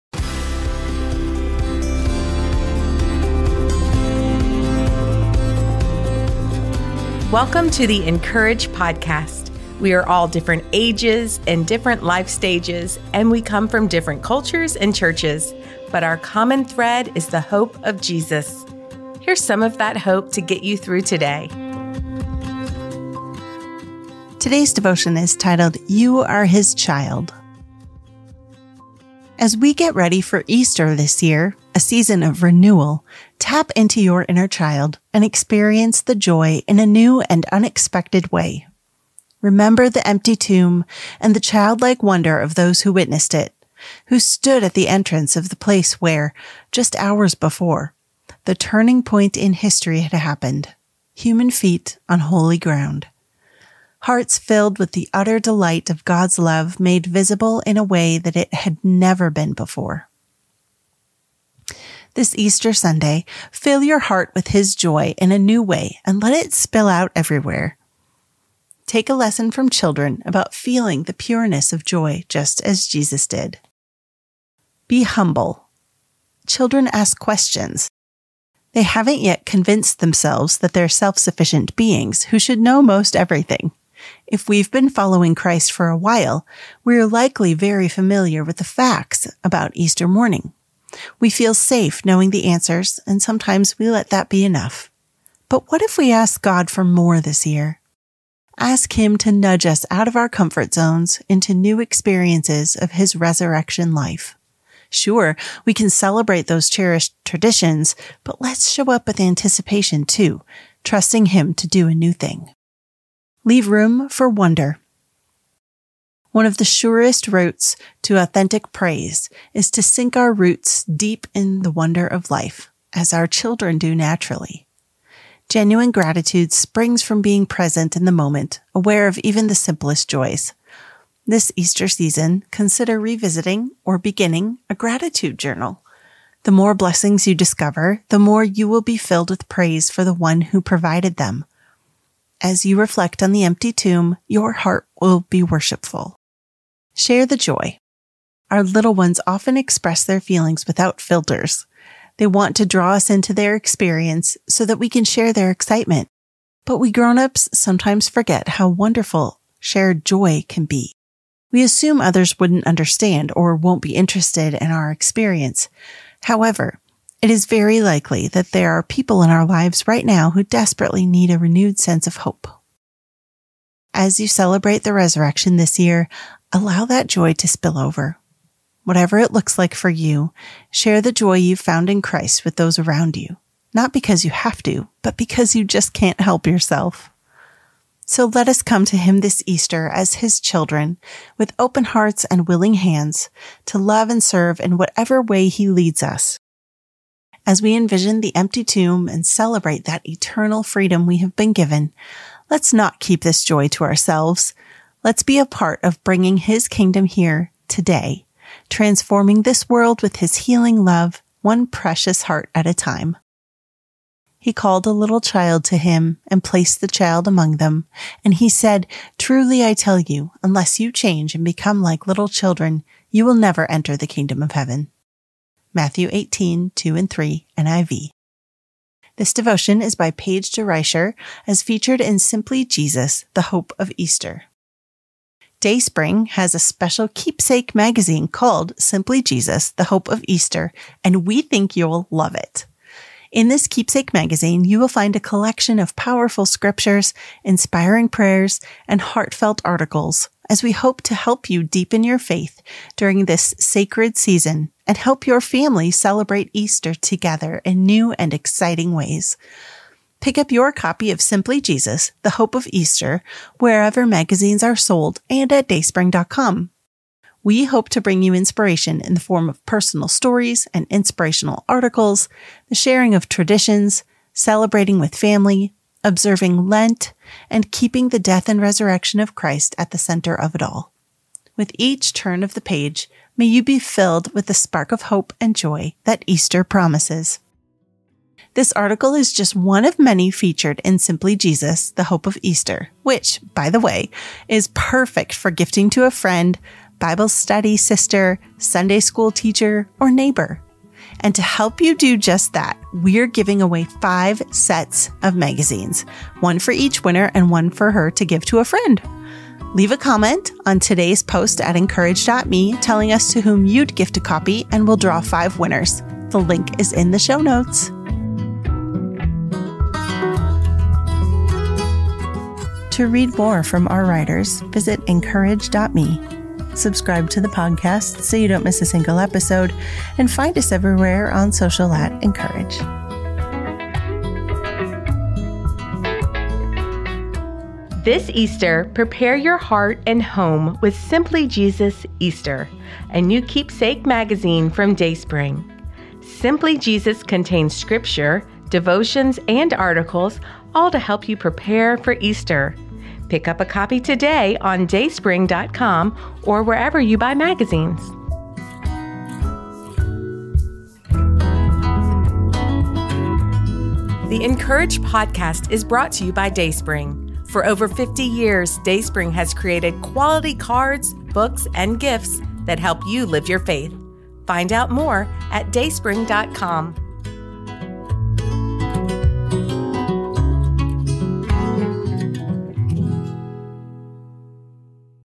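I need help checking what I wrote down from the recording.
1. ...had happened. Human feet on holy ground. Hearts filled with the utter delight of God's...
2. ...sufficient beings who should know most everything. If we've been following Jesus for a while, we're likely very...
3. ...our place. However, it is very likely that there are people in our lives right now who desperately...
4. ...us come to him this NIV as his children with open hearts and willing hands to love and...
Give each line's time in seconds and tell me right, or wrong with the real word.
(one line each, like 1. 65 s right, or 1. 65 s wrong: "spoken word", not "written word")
1. 50 s right
2. 81 s wrong: "Christ", not "Jesus"
3. 164 s wrong: "experience", not "place"
4. 188 s wrong: "Easter", not "NIV".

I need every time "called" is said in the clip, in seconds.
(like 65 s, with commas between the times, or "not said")
214 s, 238 s.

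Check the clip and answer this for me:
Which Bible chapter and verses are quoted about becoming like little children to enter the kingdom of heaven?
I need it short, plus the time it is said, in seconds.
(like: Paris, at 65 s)
Matthew 18:2-3, at 225 s.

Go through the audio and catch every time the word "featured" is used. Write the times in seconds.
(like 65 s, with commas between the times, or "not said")
231 s, 290 s.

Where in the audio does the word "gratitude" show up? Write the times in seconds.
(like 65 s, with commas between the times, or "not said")
125 s, 134 s.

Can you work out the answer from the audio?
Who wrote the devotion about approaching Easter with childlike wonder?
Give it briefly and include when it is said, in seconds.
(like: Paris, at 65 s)
Paige DeReicher, at 230 s.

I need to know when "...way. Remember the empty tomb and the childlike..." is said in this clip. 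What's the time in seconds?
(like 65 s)
38 s.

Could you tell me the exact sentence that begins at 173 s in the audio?
As you celebrate the resurrection this year, allow that joy to spill over.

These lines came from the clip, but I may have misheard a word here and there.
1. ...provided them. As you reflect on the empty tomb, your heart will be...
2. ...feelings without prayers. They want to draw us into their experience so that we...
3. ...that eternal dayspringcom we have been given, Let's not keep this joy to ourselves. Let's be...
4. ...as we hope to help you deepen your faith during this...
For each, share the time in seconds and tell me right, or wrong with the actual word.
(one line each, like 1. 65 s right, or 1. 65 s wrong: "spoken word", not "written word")
1. 140 s right
2. 150 s wrong: "filters", not "prayers"
3. 199 s wrong: "freedom", not "dayspringcom"
4. 250 s right.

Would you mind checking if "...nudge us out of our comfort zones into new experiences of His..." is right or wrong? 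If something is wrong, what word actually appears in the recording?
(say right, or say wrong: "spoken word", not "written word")
right.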